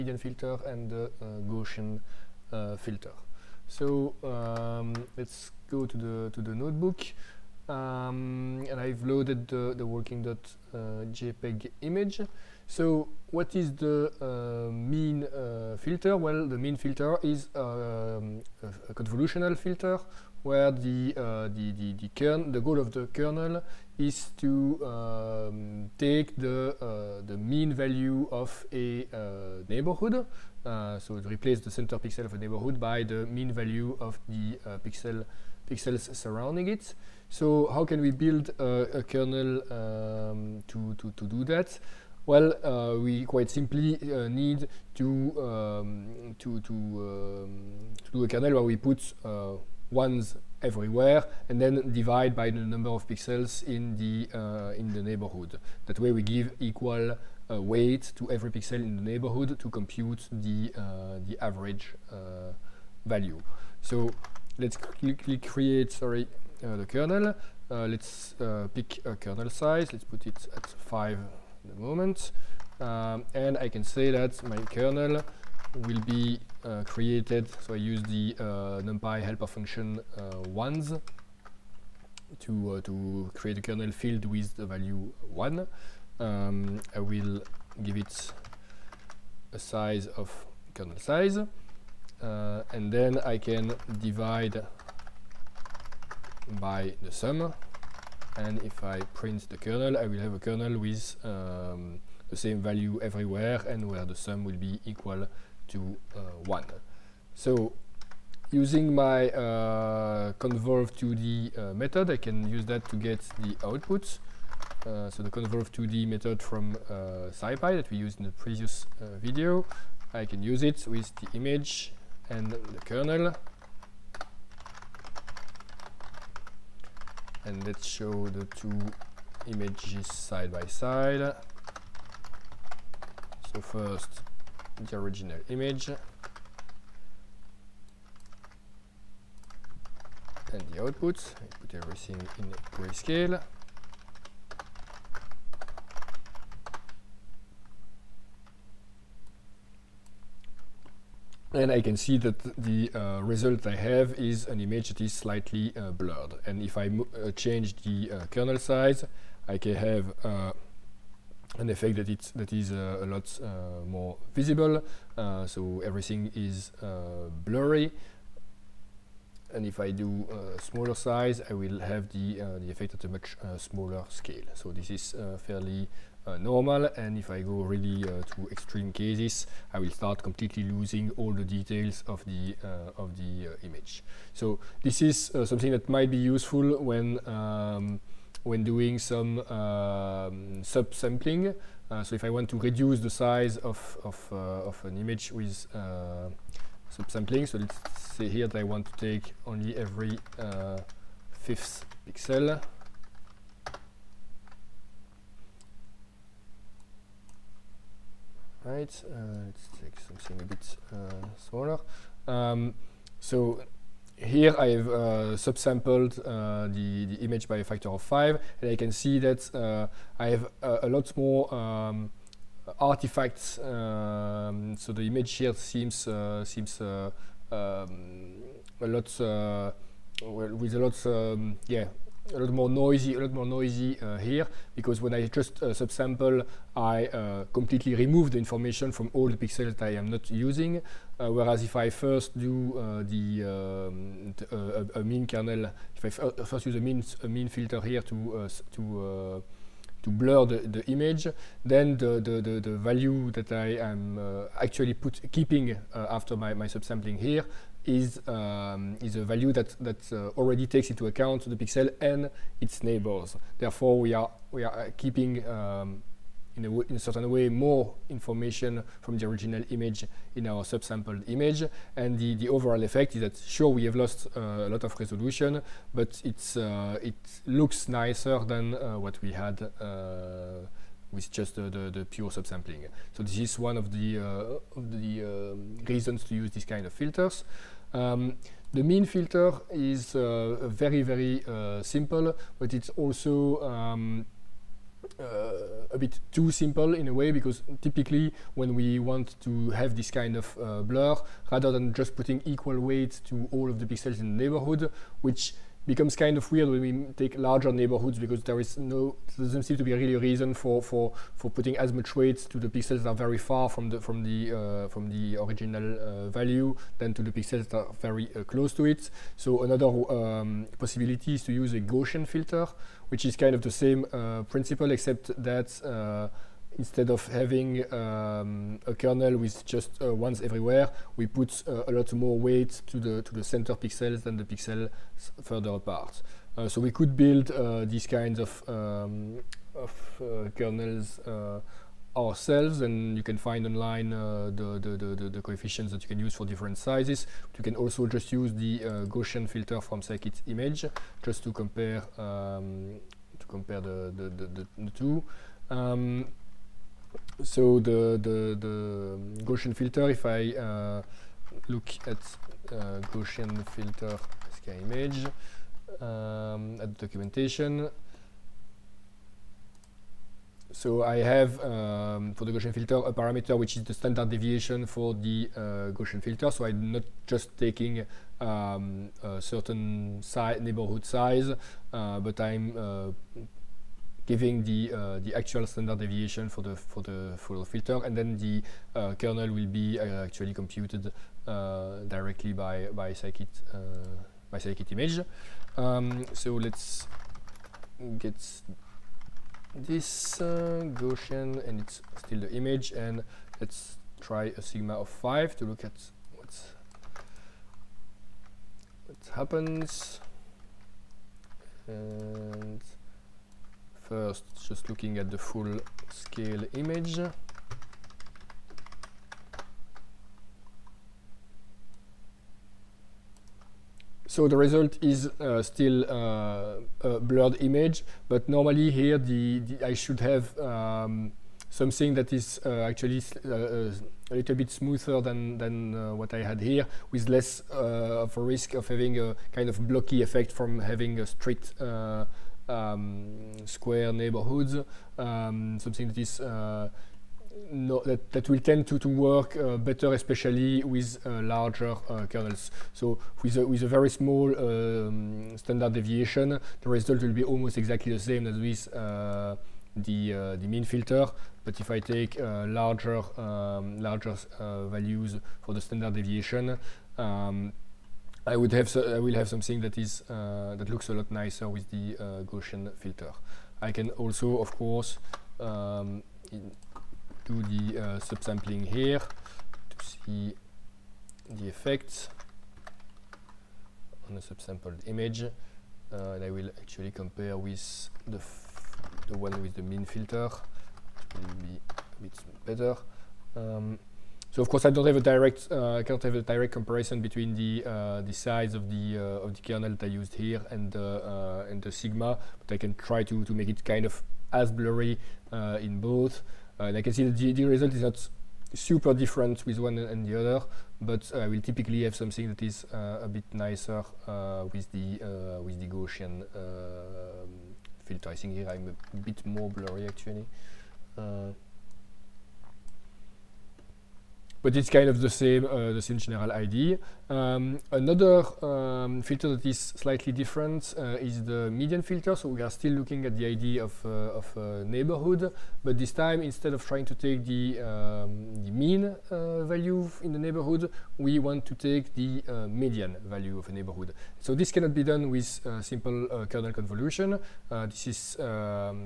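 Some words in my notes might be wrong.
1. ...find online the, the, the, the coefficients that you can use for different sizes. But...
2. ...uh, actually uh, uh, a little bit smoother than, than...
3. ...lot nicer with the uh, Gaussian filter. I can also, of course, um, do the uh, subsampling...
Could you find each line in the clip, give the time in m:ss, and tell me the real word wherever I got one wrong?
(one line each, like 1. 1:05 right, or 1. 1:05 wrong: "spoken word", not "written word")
1. 5:43 right
2. 7:12 right
3. 7:51 right.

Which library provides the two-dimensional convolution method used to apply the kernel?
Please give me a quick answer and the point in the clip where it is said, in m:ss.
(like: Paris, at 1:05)
SciPy, at 1:57.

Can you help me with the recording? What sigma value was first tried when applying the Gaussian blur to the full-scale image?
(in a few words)
5.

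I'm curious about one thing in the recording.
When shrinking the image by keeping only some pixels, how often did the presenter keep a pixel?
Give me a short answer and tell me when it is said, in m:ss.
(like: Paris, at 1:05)
every fifth pixel, at 3:19.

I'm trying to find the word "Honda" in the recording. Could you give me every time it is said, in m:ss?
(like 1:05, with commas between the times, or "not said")
not said.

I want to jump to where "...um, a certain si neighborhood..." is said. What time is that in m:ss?
6:18.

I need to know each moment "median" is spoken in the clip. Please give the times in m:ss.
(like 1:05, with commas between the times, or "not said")
8:51, 9:02.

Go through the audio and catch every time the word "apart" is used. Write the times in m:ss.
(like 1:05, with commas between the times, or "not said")
5:35.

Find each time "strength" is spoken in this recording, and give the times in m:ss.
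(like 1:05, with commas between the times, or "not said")
not said.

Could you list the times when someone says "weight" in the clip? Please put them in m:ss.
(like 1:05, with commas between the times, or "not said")
0:57, 5:02, 5:12, 5:32.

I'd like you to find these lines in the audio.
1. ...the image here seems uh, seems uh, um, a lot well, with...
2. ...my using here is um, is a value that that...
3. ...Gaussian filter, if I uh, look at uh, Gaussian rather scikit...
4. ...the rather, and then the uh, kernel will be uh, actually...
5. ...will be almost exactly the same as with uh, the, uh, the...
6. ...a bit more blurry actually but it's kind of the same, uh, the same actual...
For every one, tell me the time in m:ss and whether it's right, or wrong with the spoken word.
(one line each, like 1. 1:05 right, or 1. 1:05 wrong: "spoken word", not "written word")
1. 3:44 right
2. 4:16 wrong: "subsampling", not "using"
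3. 5:59 wrong: "filter", not "rather"
4. 6:27 wrong: "filter", not "rather"
5. 7:37 right
6. 8:39 wrong: "general", not "actual".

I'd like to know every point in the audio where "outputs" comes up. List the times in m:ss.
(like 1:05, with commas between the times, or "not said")
1:53, 2:20.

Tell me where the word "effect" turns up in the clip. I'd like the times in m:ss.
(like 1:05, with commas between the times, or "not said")
2:41, 2:52, 4:32, 7:20, 8:01.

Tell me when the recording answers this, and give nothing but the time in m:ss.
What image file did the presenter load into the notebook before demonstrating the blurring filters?
0:09.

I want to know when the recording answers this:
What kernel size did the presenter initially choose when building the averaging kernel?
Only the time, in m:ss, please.
1:09.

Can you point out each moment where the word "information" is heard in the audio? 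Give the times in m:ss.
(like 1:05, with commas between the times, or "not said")
3:58, 4:28.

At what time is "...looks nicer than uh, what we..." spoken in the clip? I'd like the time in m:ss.
4:37.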